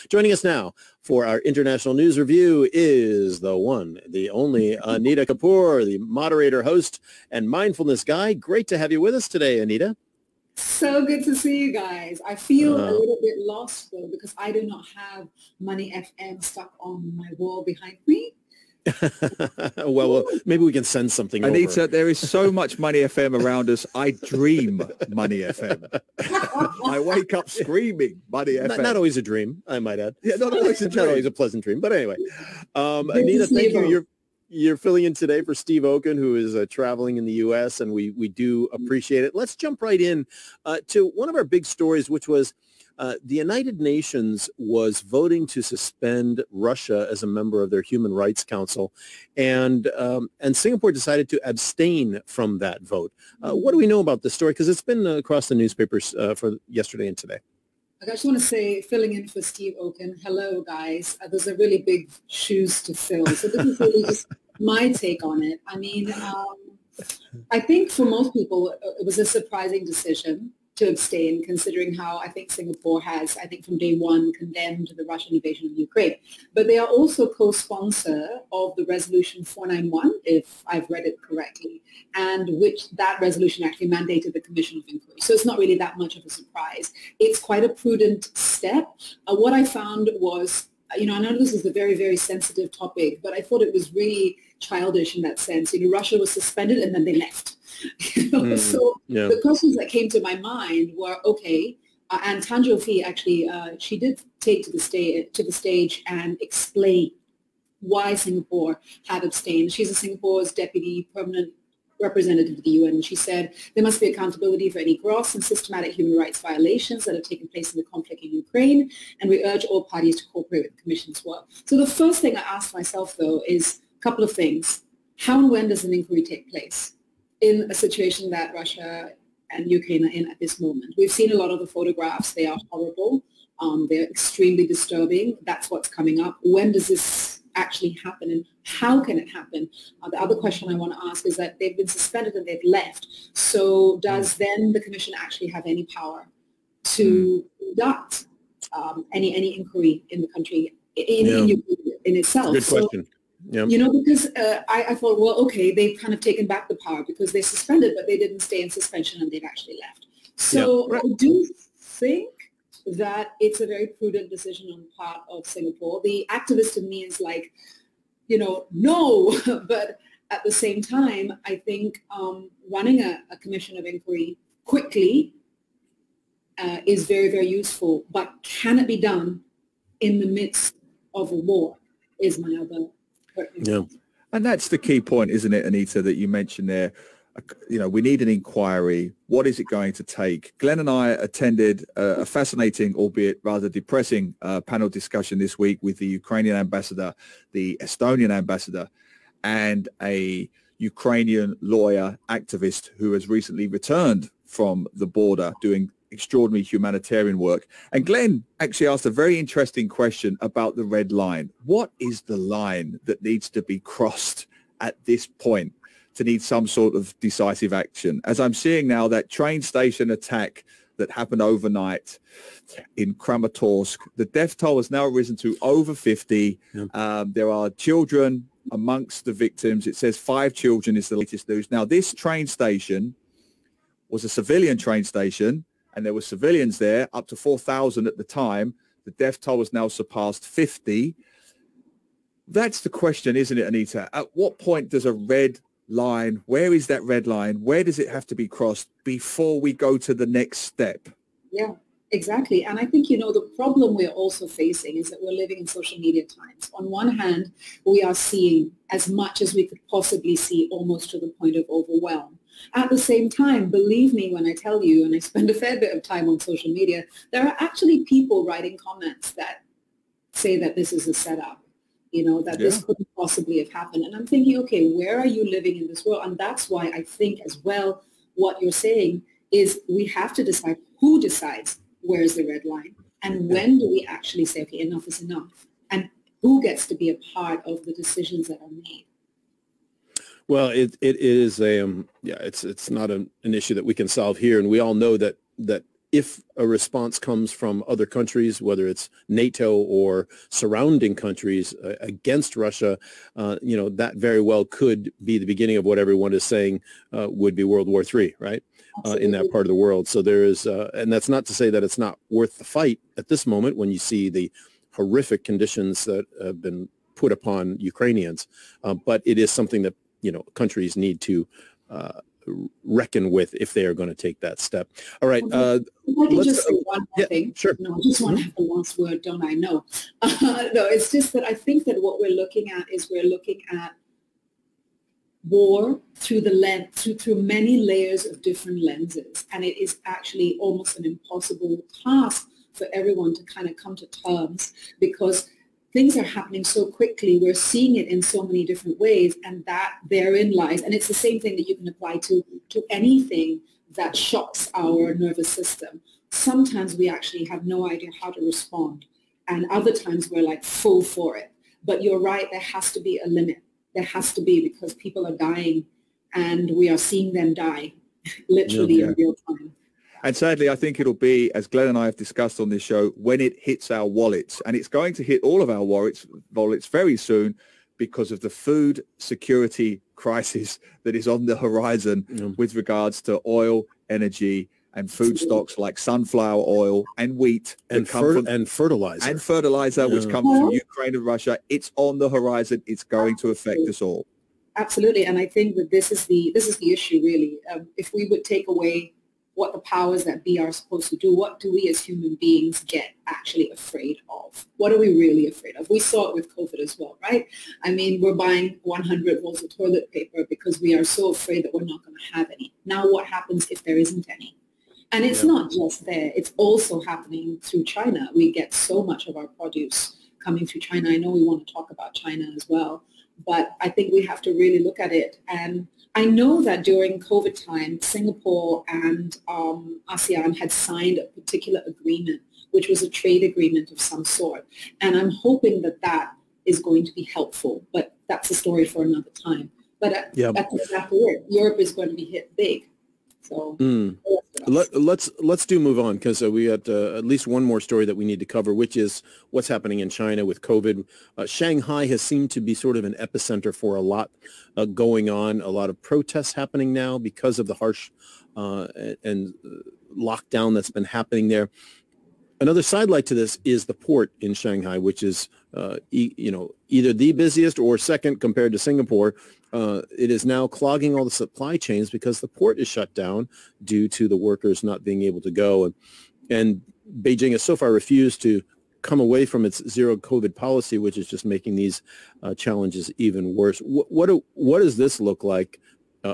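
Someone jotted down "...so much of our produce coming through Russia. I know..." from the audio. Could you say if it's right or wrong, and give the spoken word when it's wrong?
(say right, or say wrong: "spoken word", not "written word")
wrong: "China", not "Russia".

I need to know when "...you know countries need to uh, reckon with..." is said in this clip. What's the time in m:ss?
5:20.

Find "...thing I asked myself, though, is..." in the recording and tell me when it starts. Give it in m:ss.
2:02.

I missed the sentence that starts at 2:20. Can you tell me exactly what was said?
Uh, the other question I want to ask is that they've been suspended and they've left.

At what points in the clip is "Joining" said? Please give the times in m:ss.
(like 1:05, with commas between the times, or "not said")
0:00.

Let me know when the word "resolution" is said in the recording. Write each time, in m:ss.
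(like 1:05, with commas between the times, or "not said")
1:18, 1:23.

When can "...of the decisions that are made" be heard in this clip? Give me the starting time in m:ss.
4:47.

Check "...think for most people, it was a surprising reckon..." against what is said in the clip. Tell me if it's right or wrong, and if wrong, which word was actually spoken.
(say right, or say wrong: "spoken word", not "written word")
wrong: "decision", not "reckon".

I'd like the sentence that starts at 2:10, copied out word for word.
We've seen a lot of the photographs.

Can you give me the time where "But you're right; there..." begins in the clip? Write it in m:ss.
6:01.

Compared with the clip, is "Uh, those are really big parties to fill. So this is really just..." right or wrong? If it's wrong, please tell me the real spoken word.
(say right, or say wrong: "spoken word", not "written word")
wrong: "shoes", not "parties".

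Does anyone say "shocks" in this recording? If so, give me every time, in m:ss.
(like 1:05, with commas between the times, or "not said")
5:54.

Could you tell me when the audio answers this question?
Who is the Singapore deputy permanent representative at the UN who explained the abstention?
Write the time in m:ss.
1:42.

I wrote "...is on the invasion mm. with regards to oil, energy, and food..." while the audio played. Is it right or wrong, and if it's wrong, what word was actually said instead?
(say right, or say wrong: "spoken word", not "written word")
wrong: "horizon", not "invasion".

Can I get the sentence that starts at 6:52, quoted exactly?
Now what happens if there isn't any?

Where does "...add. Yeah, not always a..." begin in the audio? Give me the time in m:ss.
0:29.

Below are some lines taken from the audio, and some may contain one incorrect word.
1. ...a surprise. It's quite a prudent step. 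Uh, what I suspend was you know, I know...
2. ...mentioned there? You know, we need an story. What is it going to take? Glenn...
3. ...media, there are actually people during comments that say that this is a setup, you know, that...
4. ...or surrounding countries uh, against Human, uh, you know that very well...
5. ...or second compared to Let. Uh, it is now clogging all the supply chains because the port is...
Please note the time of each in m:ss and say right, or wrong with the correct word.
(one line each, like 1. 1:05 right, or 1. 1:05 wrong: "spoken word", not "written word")
1. 1:26 wrong: "found", not "suspend"
2. 3:06 wrong: "inquiry", not "story"
3. 4:26 wrong: "writing", not "during"
4. 4:59 wrong: "Russia", not "Human"
5. 7:47 wrong: "Singapore", not "Let".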